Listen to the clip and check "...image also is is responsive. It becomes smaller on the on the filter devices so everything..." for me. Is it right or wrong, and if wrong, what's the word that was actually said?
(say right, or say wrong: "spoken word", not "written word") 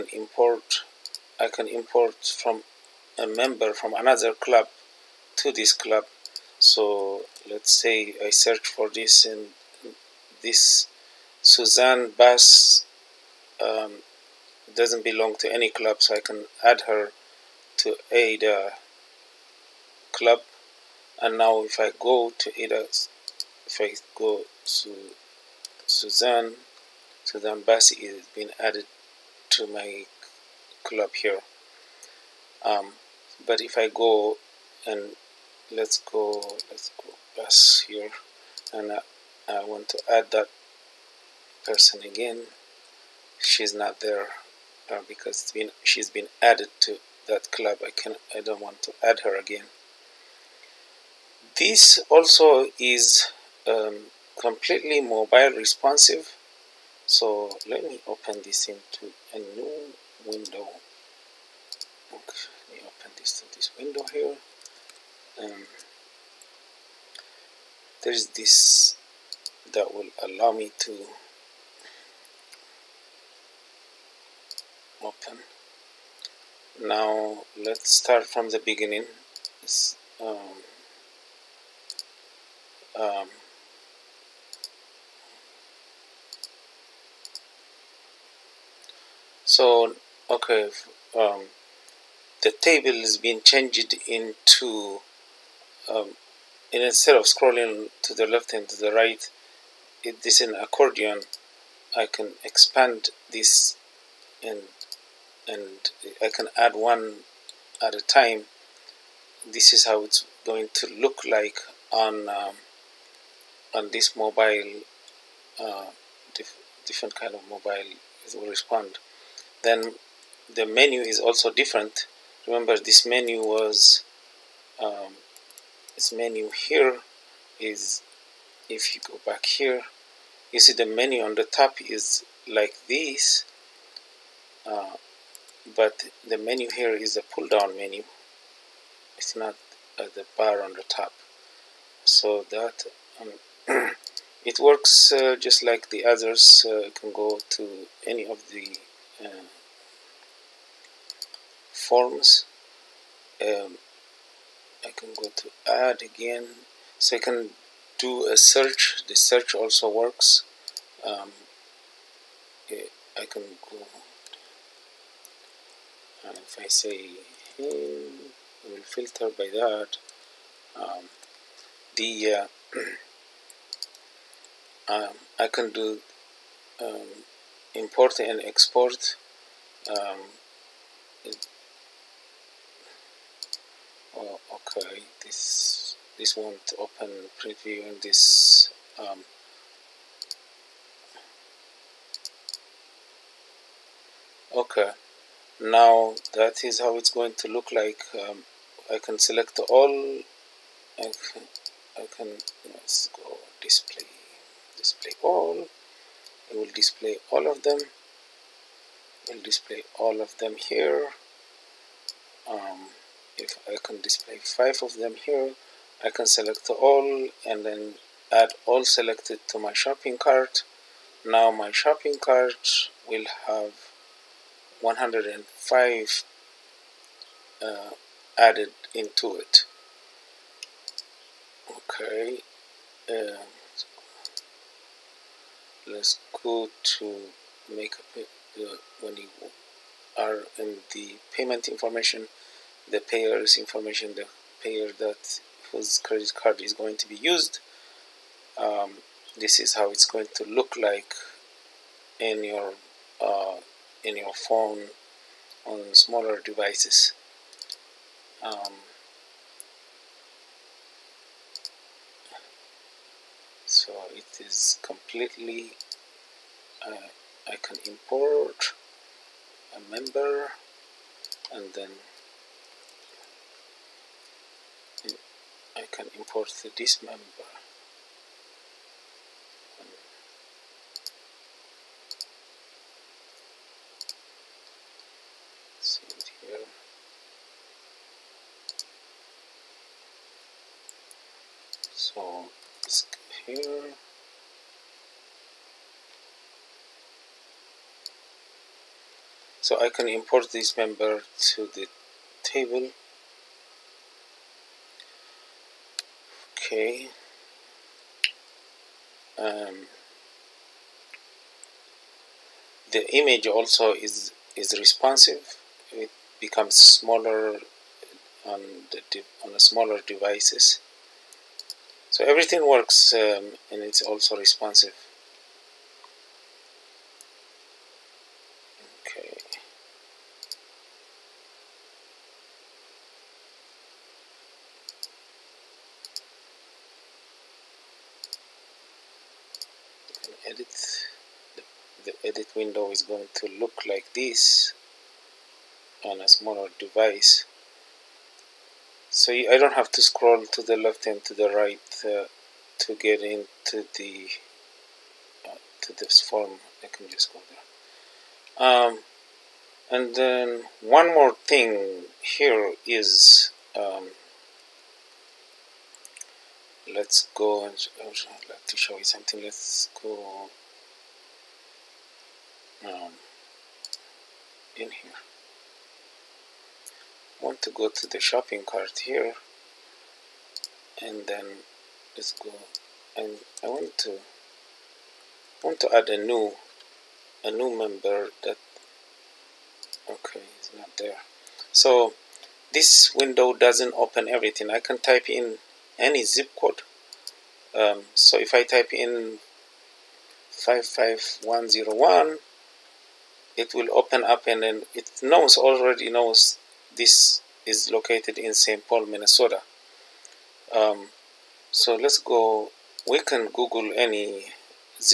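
wrong: "smaller", not "filter".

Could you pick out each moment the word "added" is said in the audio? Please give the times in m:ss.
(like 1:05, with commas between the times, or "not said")
0:28, 0:46, 3:48.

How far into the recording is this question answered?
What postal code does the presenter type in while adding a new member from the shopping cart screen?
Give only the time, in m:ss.
6:40.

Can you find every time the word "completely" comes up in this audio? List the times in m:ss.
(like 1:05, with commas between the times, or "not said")
0:54, 4:24.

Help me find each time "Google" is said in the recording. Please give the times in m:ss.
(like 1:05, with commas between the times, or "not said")
6:53.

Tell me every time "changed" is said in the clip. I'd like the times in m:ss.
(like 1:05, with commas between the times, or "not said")
1:33.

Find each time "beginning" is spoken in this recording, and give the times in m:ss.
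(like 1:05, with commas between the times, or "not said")
1:18.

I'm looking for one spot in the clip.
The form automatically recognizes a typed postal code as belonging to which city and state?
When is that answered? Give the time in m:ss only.
6:48.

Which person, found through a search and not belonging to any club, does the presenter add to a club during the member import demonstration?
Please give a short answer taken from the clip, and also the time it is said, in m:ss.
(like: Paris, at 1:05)
Suzanne Bass, at 0:11.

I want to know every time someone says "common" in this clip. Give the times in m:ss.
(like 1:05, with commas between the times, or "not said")
not said.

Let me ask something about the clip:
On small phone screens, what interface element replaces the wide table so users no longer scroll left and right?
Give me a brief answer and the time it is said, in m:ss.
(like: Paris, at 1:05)
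an accordion, at 1:40.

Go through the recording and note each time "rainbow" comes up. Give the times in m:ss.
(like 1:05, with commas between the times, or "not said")
not said.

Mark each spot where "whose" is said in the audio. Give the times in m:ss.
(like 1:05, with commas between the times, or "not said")
4:05.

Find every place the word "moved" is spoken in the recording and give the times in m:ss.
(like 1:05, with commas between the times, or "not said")
not said.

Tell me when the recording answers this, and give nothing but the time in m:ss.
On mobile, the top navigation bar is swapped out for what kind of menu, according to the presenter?
2:17.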